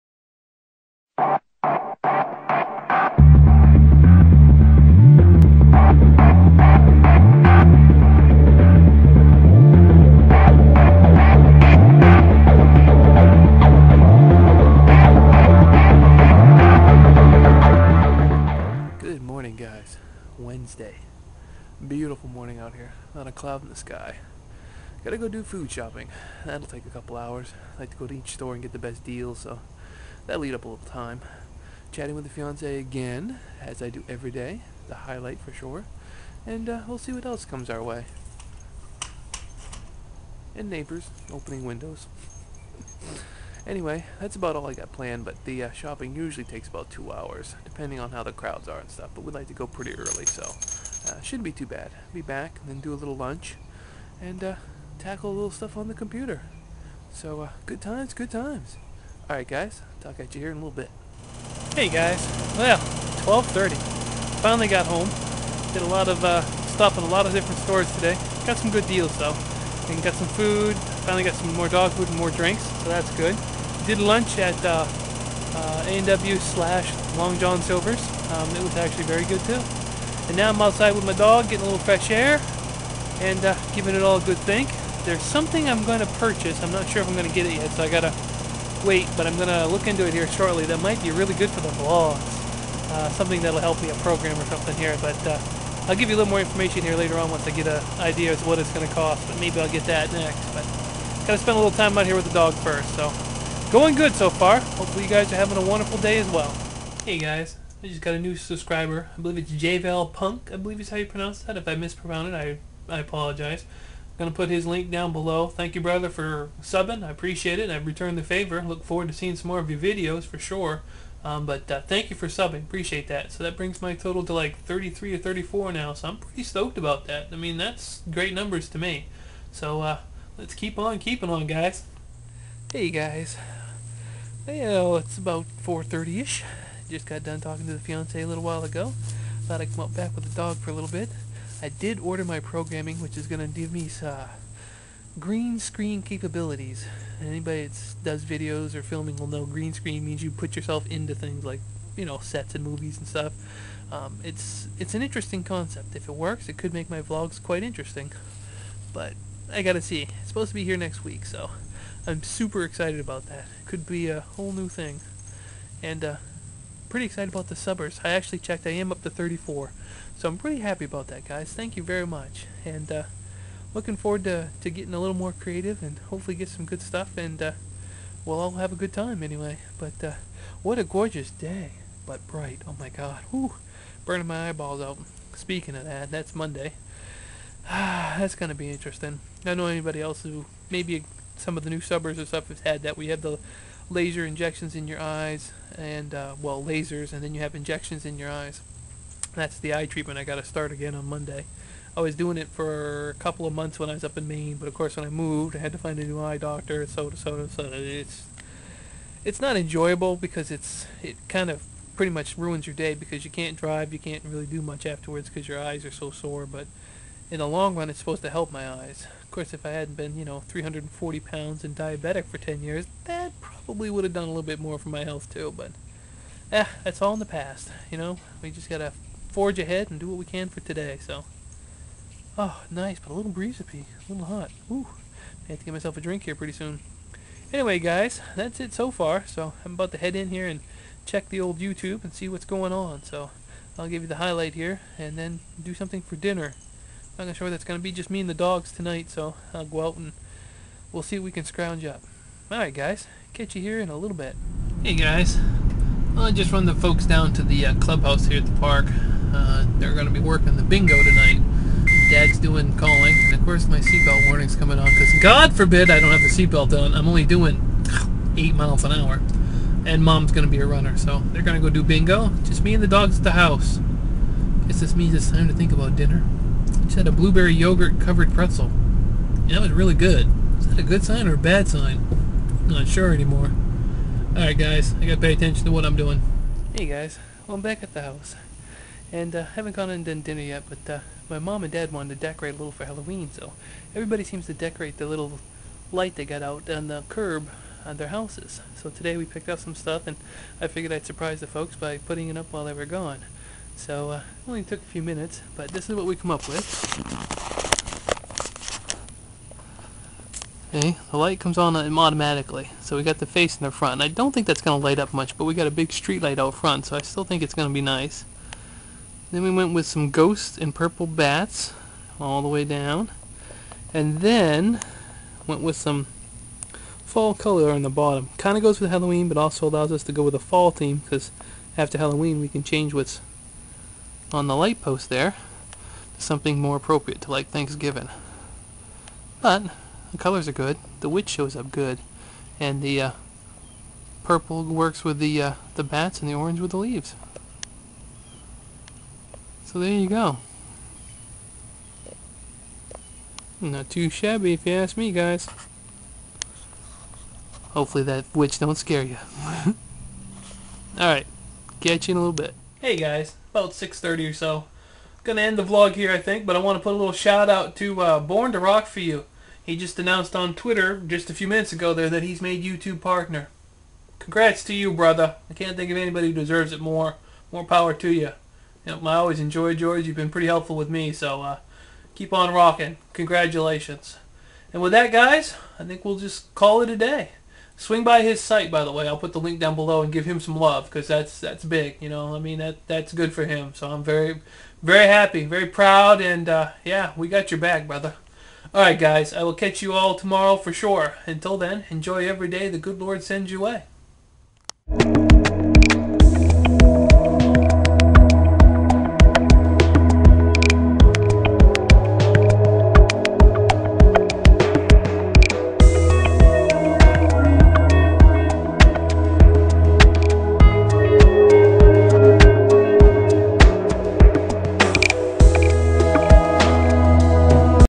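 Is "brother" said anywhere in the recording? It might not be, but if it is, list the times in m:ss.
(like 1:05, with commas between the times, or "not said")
1:55, 6:14, 6:37.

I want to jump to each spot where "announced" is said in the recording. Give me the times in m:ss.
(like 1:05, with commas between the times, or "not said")
6:09.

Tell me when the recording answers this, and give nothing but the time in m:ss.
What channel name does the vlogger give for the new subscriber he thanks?
1:49.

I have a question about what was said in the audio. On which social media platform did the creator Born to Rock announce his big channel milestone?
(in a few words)
Twitter.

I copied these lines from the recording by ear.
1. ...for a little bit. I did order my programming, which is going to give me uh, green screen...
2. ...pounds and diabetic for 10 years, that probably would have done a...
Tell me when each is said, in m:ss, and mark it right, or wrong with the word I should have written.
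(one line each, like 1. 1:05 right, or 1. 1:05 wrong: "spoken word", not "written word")
1. 2:20 right
2. 3:41 right.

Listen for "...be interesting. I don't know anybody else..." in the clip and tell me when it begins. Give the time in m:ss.
3:08.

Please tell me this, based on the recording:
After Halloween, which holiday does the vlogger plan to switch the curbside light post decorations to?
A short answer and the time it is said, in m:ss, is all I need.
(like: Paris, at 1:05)
Thanksgiving, at 5:37.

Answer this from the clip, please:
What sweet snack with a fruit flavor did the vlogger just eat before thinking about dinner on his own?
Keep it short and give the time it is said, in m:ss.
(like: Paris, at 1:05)
Blueberry yogurt covered pretzel, at 4:37.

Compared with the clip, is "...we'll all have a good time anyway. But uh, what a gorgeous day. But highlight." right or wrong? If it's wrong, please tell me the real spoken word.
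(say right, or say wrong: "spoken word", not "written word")
wrong: "bright", not "highlight".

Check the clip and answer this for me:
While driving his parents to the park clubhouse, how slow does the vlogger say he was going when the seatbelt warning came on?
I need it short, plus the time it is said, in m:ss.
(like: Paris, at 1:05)
8 miles an hour, at 4:28.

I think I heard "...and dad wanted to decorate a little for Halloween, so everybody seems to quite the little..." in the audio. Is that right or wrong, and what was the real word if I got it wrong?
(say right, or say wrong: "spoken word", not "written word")
wrong: "decorate", not "quite".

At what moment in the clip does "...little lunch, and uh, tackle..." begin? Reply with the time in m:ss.
0:52.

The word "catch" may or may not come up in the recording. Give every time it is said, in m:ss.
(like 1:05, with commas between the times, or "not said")
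4:13, 6:01, 6:39.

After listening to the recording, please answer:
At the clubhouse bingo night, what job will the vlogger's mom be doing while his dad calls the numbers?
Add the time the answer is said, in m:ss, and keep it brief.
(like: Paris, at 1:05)
Runner, at 4:30.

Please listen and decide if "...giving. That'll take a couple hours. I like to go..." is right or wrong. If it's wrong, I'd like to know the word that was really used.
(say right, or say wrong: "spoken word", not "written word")
wrong: "shopping", not "giving".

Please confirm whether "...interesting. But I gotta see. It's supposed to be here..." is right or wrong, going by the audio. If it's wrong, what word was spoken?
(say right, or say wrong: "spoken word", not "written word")
right.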